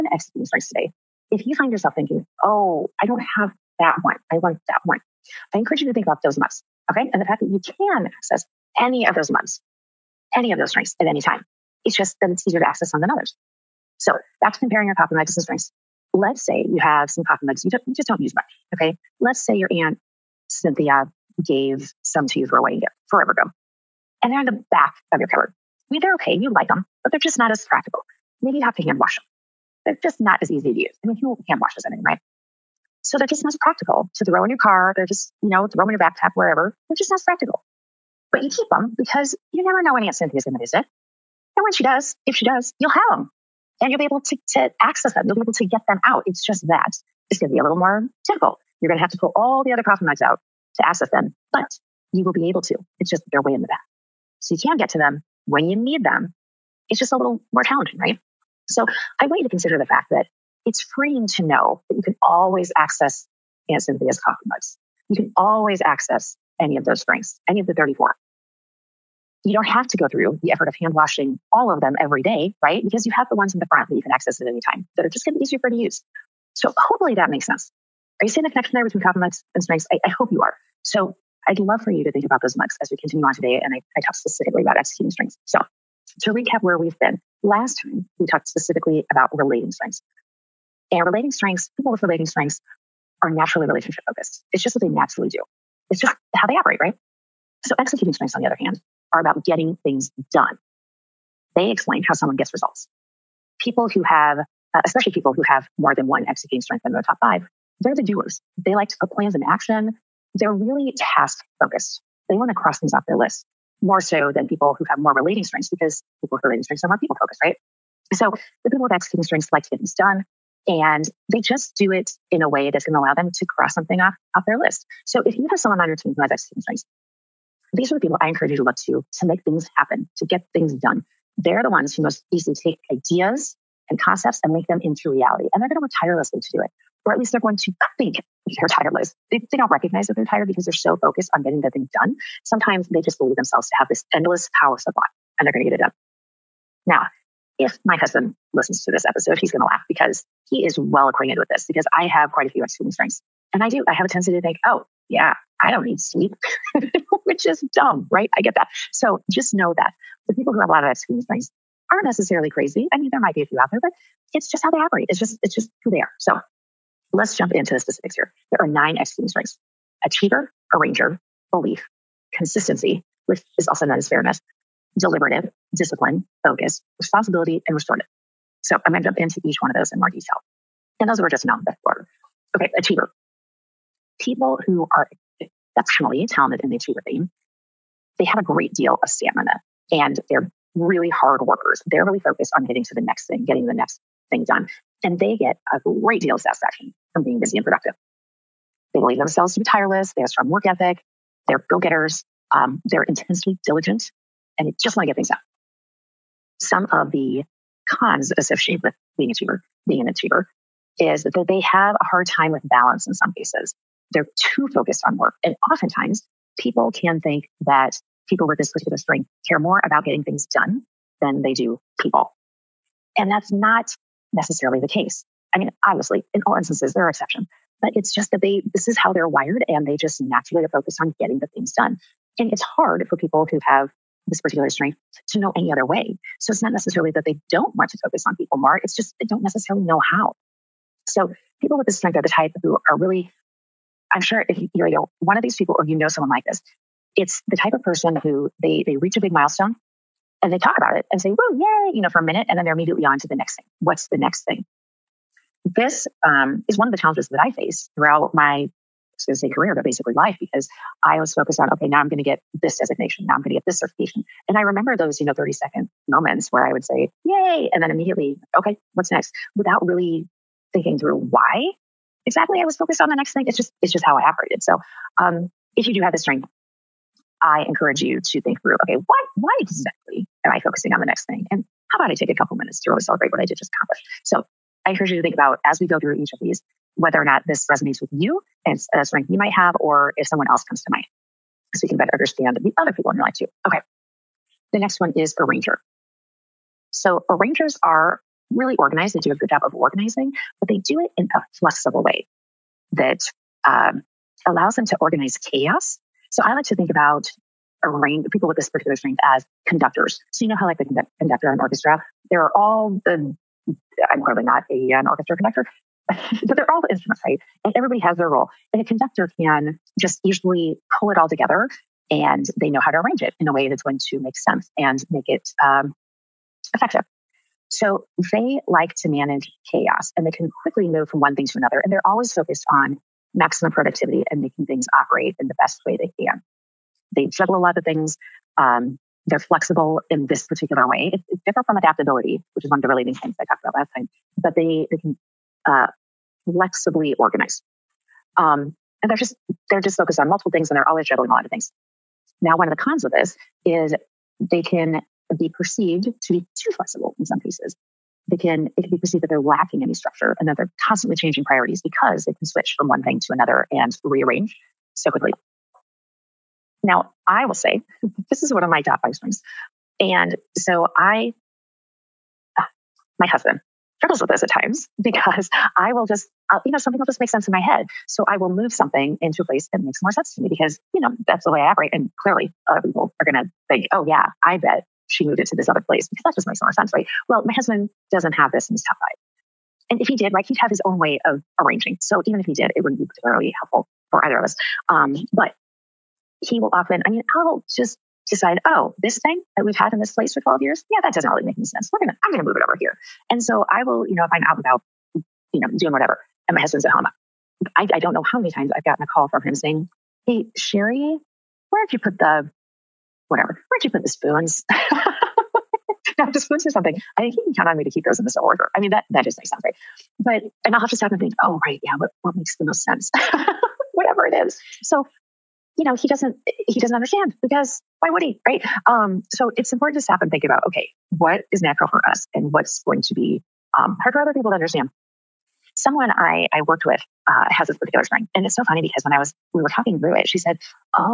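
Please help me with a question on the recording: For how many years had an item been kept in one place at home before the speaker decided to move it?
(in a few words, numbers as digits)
12.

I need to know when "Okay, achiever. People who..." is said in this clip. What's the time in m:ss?
3:02.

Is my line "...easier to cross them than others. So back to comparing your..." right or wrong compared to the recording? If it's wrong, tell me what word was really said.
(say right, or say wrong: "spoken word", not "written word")
wrong: "access", not "cross".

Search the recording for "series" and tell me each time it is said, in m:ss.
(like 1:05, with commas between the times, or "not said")
not said.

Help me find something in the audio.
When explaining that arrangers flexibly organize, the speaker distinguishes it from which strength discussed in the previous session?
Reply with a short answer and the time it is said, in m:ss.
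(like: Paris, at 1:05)
Adaptability, at 5:41.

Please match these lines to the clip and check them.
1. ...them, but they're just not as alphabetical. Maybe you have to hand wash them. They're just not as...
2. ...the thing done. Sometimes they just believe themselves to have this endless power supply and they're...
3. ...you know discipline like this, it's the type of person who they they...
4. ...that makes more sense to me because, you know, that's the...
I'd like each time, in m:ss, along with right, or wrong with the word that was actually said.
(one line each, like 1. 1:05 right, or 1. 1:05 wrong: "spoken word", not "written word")
1. 0:26 wrong: "practical", not "alphabetical"
2. 2:21 right
3. 4:05 wrong: "someone", not "discipline"
4. 6:19 right.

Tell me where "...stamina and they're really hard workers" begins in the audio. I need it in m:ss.
3:09.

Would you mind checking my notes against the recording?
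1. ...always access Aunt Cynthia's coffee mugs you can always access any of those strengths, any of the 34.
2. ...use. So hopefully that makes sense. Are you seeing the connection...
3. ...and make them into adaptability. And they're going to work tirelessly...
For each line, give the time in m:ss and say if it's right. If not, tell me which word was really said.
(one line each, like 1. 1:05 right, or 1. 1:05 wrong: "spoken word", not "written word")
1. 1:02 right
2. 1:15 right
3. 2:14 wrong: "reality", not "adaptability".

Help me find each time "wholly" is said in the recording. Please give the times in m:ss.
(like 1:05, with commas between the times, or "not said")
not said.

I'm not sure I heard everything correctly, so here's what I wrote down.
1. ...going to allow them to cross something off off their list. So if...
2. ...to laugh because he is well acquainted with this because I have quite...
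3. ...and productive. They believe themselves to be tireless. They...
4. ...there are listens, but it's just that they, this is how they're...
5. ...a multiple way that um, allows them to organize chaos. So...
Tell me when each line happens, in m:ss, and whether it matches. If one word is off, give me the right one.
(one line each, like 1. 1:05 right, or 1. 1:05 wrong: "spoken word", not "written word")
1. 2:02 right
2. 2:29 right
3. 3:17 right
4. 3:46 wrong: "exceptions", not "listens"
5. 5:01 wrong: "flexible", not "multiple".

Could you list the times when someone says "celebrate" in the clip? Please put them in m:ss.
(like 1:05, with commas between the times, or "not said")
4:42.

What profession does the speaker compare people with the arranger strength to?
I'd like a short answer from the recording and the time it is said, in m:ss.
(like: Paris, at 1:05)
Conductors, at 5:09.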